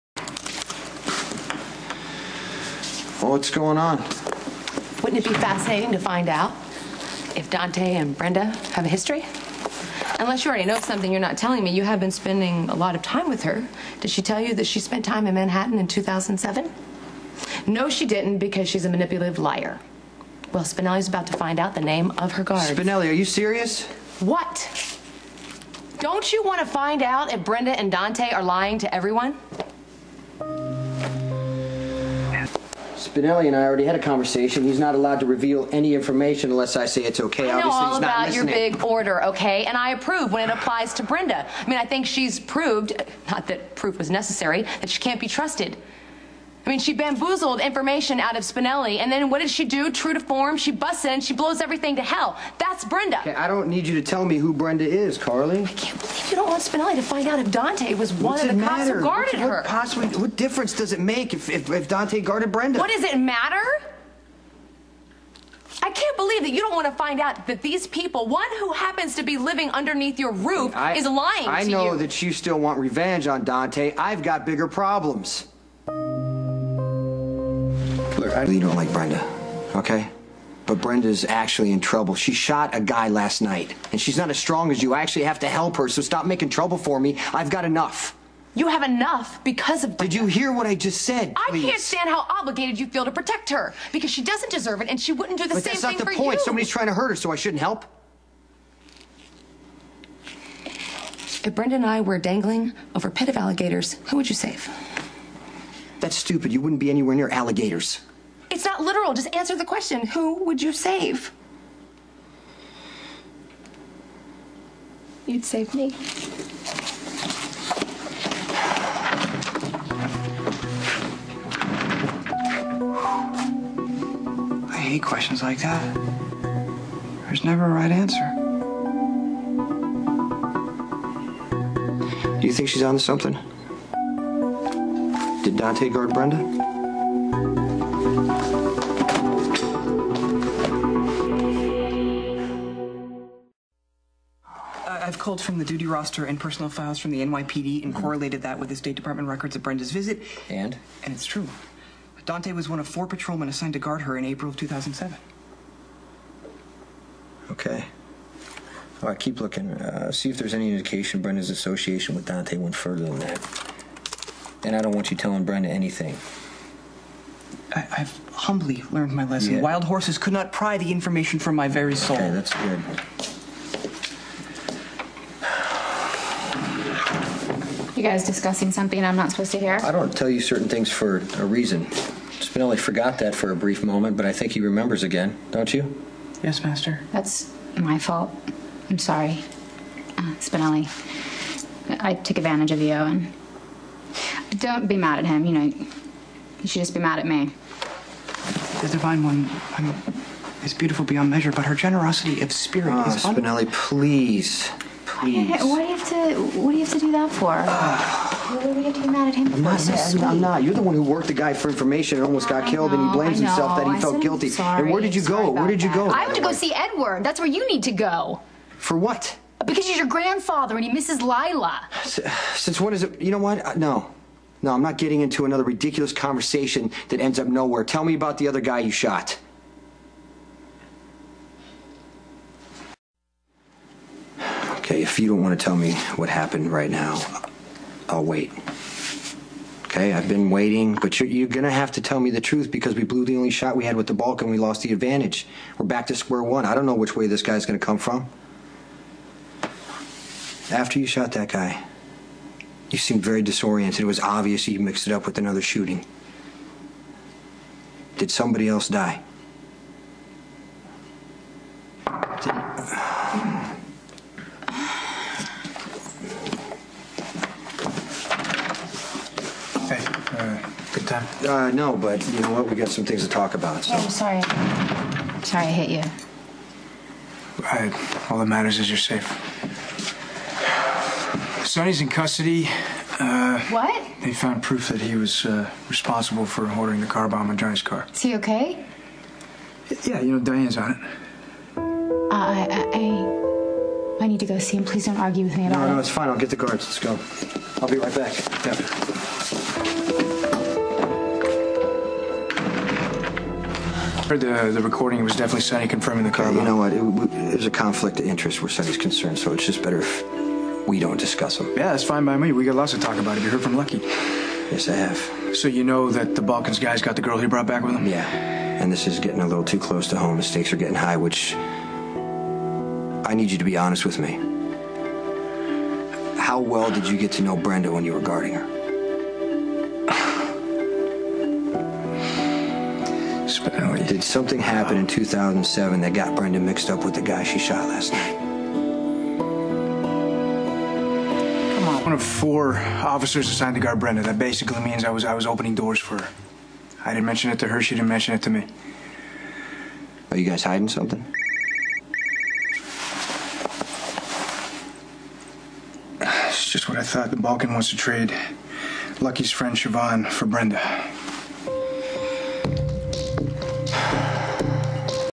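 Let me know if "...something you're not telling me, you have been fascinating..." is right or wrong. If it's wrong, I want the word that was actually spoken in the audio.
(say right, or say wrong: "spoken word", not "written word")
wrong: "spending", not "fascinating".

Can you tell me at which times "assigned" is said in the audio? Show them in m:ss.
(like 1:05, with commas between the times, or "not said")
2:33, 5:43.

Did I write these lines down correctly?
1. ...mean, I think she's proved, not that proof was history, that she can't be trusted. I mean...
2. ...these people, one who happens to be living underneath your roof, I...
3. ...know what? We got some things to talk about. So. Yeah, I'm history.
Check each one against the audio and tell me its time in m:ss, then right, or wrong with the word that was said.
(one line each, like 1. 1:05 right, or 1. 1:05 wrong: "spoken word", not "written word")
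1. 0:41 wrong: "necessary", not "history"
2. 1:07 right
3. 4:32 wrong: "sorry", not "history".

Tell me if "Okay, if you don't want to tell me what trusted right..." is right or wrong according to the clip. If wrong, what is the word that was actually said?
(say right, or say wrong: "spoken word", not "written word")
wrong: "happened", not "trusted".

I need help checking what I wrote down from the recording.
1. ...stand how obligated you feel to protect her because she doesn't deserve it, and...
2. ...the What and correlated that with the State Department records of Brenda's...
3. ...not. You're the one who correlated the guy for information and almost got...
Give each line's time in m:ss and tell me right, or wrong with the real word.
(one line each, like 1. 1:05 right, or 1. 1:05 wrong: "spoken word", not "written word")
1. 1:31 right
2. 2:27 wrong: "NYPD", not "What"
3. 3:30 wrong: "worked", not "correlated".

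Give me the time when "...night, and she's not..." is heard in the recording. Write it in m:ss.
1:23.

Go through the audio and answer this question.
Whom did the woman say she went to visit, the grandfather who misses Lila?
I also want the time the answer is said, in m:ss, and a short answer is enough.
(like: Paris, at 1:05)
Edward, at 3:36.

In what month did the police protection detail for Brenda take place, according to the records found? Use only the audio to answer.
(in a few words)
April.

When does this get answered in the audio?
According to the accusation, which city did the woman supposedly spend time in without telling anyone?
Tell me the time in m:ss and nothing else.
0:15.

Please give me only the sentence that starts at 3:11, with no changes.
I took advantage of you, and don't be mad at him.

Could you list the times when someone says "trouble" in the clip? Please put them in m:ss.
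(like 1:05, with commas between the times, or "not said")
1:21, 1:26.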